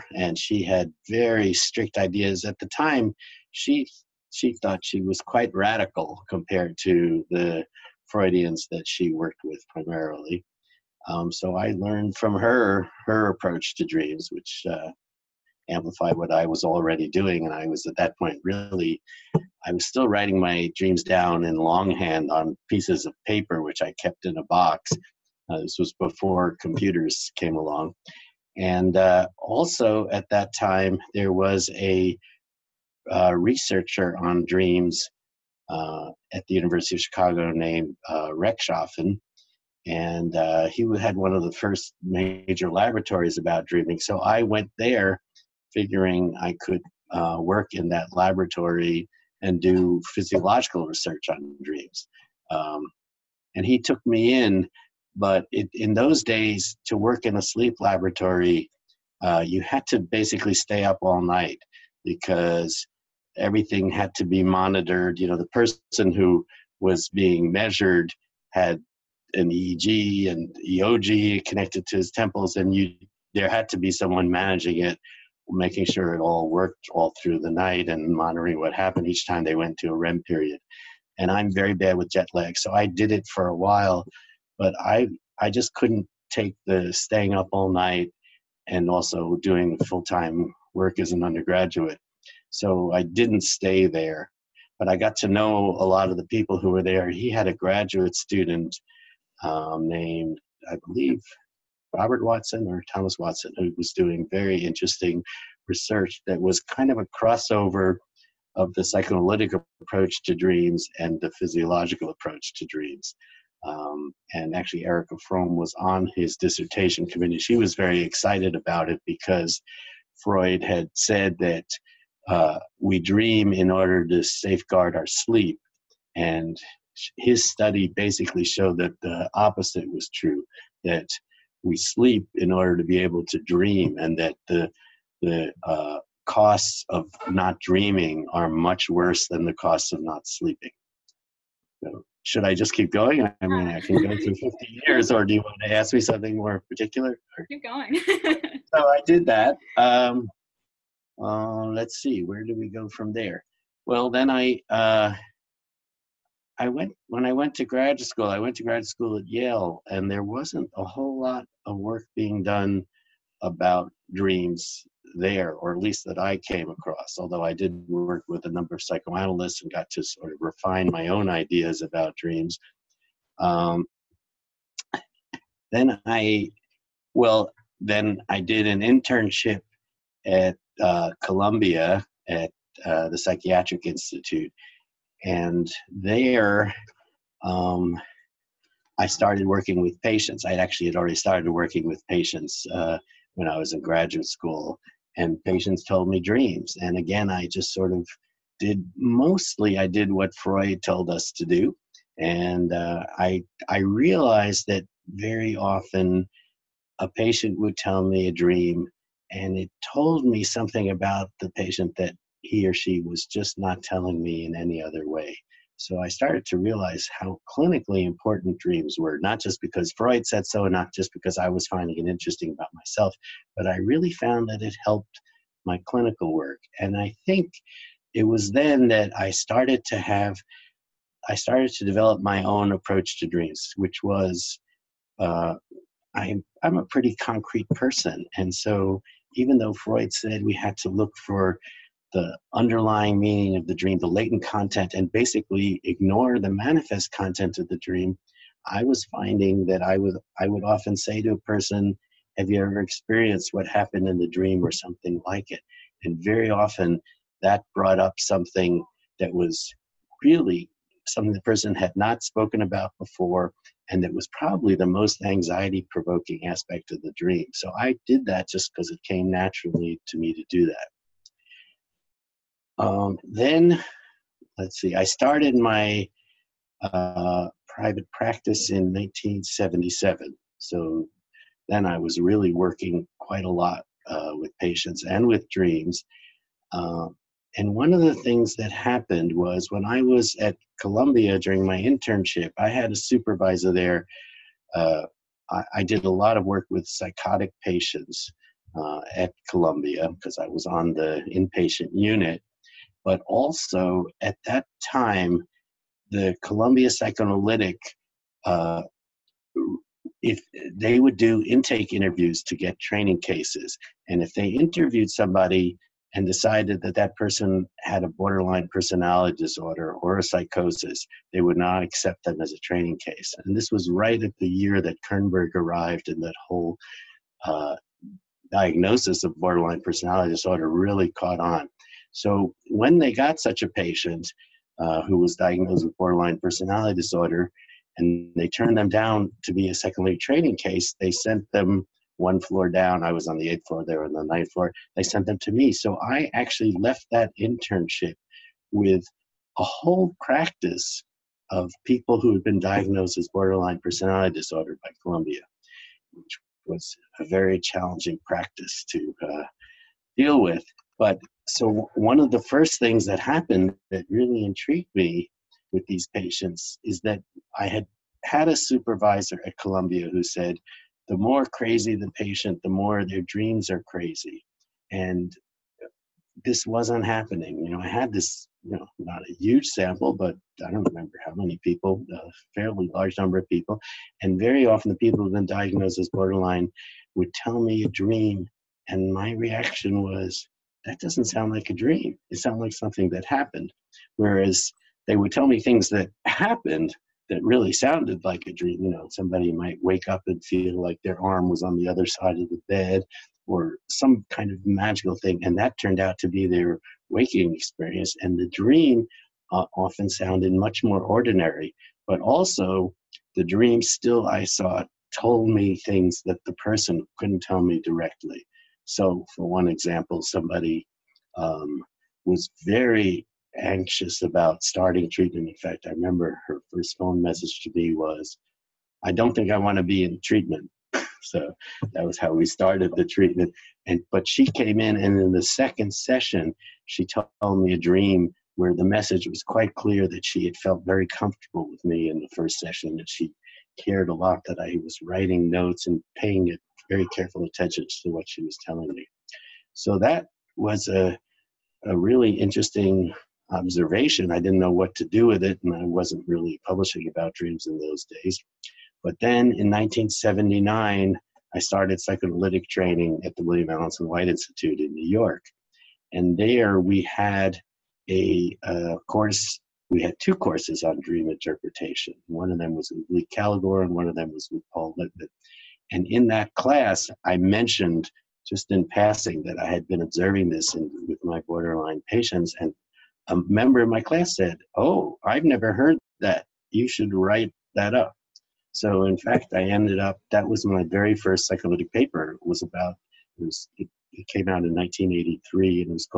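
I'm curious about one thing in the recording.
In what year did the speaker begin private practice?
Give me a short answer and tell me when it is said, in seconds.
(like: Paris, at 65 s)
1977, at 278 s.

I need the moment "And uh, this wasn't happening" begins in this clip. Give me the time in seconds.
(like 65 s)
374 s.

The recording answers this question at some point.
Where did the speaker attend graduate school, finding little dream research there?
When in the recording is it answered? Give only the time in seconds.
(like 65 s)
159 s.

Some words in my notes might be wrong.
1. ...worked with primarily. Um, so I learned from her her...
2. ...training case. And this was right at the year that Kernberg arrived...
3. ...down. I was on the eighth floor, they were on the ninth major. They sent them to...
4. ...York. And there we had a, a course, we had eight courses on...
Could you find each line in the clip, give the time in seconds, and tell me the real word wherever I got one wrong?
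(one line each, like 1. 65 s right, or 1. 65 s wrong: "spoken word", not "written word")
1. 9 s right
2. 322 s right
3. 342 s wrong: "floor", not "major"
4. 465 s wrong: "two", not "eight".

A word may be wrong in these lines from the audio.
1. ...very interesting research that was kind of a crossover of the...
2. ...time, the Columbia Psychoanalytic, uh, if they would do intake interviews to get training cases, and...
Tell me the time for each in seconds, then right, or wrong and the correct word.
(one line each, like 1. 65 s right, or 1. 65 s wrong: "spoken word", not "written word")
1. 104 s right
2. 304 s right.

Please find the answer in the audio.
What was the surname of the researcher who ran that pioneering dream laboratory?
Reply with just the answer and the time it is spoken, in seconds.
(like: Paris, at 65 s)
Rechtschaffen, at 38 s.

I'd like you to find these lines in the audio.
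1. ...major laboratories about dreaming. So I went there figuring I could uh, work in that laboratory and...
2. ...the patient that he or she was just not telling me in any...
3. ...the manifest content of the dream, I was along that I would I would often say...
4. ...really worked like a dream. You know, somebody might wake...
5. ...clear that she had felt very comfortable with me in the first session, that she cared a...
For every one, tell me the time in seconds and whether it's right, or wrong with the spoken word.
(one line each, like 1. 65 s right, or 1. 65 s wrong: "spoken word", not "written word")
1. 42 s right
2. 211 s right
3. 246 s wrong: "finding", not "along"
4. 397 s wrong: "sounded", not "worked"
5. 439 s right.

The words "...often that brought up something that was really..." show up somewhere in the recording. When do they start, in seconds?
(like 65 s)
256 s.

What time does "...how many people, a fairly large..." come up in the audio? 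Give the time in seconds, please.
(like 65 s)
381 s.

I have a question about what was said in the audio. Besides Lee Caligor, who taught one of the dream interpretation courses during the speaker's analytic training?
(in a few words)
Paul Lippmann.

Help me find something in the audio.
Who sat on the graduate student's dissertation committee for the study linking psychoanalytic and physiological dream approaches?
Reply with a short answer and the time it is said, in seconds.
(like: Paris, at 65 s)
Erika Fromm, at 114 s.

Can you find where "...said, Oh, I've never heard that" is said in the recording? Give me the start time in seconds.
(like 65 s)
484 s.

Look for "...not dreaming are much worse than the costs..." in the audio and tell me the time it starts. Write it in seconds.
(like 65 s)
137 s.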